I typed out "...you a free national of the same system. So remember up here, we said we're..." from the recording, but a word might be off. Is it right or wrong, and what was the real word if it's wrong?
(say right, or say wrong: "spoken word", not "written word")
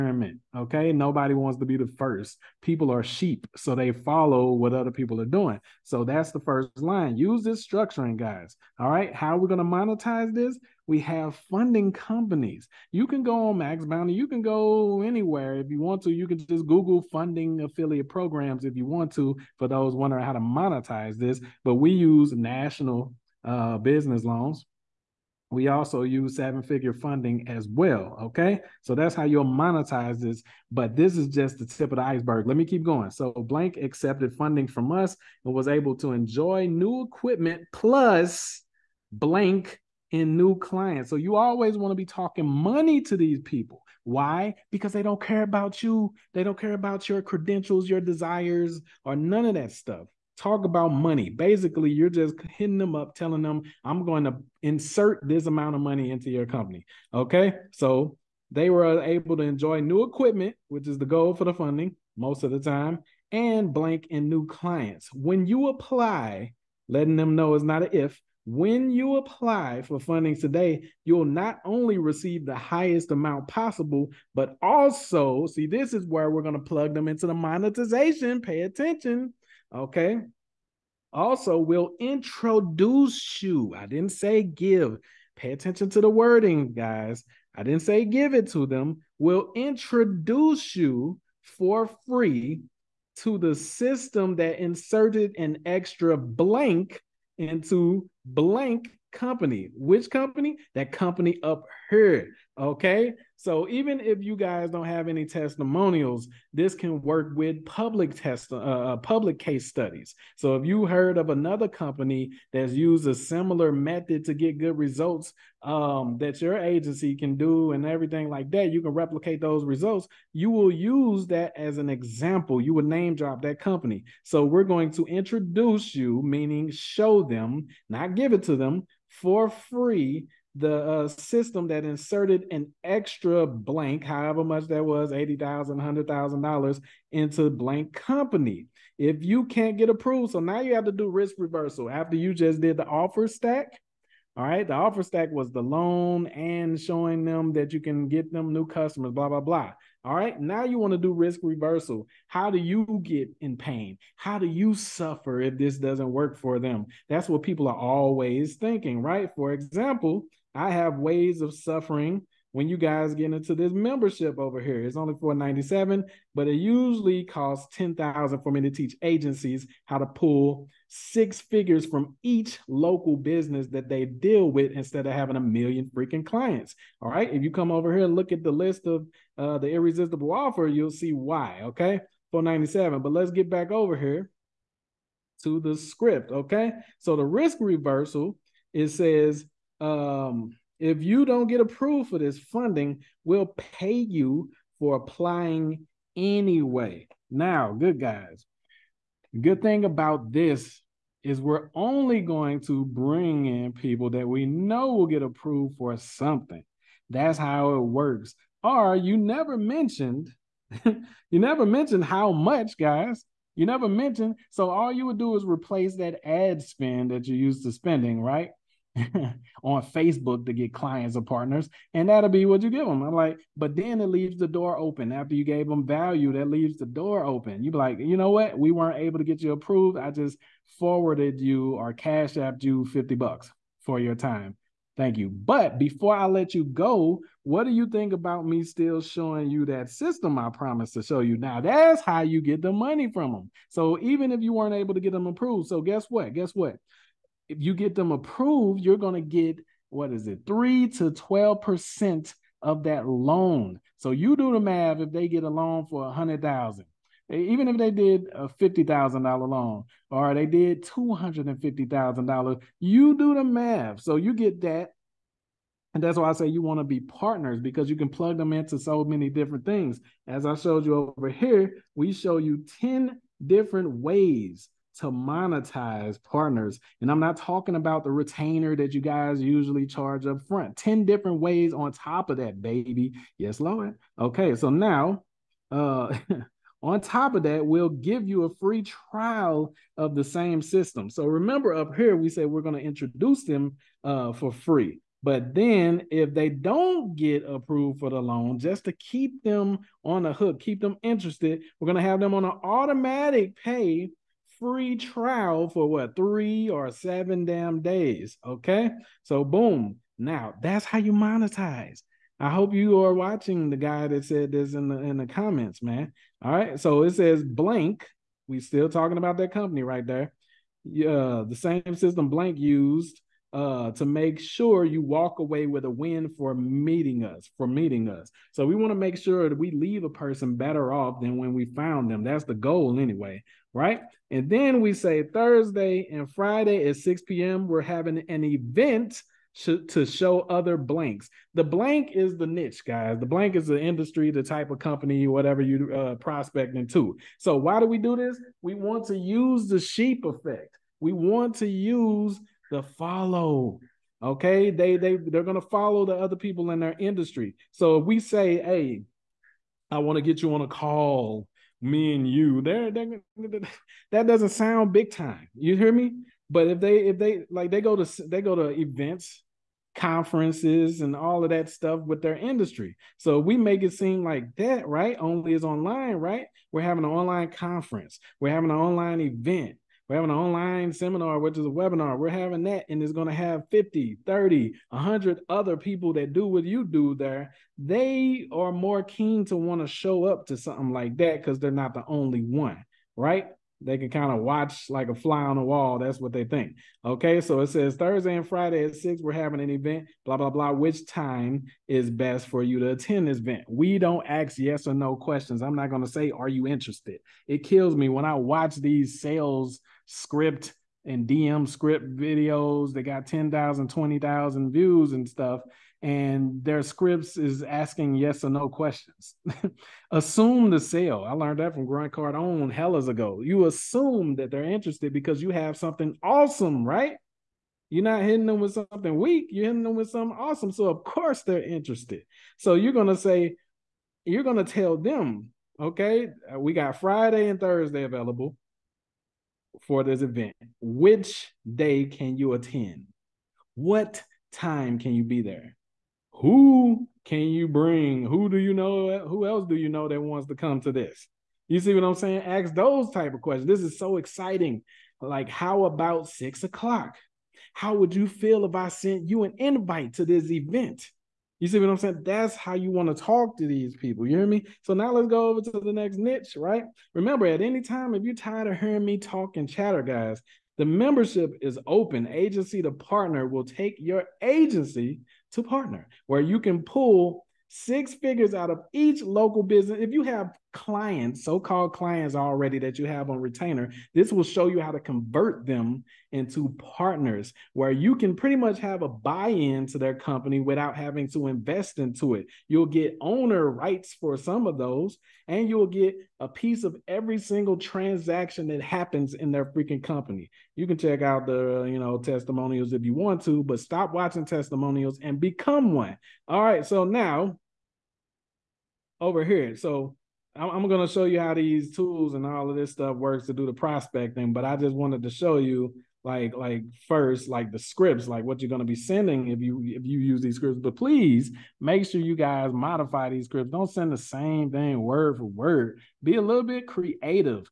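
wrong: "trial", not "national".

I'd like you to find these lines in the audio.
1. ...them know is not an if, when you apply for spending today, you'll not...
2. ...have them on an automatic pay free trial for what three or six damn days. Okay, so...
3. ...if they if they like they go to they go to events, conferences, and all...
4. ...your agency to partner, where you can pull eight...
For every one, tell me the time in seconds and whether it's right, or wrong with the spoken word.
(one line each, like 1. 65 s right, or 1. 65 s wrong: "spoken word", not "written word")
1. 67 s wrong: "funding", not "spending"
2. 302 s wrong: "seven", not "six"
3. 366 s right
4. 473 s wrong: "six", not "eight".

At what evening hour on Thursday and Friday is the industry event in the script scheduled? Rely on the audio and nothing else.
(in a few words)
6 p.m.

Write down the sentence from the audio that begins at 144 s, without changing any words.
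All right, the offer stack was the loan and showing them that you can get them new customers, blah, blah, blah.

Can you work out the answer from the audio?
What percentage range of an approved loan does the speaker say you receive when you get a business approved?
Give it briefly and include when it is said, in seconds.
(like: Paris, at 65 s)
3 to 12%, at 250 s.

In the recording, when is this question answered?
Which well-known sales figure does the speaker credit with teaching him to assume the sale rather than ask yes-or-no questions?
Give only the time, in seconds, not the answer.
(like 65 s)
421 s.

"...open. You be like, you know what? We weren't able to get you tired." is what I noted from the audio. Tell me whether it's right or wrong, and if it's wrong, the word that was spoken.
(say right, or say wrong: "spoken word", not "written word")
wrong: "approved", not "tired".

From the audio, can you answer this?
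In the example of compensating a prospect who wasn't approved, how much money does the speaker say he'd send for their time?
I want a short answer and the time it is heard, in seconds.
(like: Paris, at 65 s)
50 bucks, at 232 s.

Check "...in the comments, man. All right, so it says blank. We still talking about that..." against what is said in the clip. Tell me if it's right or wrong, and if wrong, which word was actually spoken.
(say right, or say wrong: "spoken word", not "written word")
right.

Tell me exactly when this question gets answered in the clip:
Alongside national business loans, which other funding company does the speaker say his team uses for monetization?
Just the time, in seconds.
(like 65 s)
26 s.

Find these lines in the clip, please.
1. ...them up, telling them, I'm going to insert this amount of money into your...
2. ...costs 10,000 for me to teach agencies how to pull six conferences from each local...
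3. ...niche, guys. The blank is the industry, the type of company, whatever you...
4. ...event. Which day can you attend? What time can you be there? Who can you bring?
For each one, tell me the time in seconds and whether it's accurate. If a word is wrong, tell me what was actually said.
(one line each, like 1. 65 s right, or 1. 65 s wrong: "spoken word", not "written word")
1. 52 s right
2. 167 s wrong: "figures", not "conferences"
3. 342 s right
4. 440 s right.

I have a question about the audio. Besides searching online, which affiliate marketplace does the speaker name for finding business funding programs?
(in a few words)
Max Bounty.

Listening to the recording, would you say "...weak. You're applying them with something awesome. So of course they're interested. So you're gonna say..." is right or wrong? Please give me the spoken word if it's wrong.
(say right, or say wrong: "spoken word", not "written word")
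wrong: "hitting", not "applying".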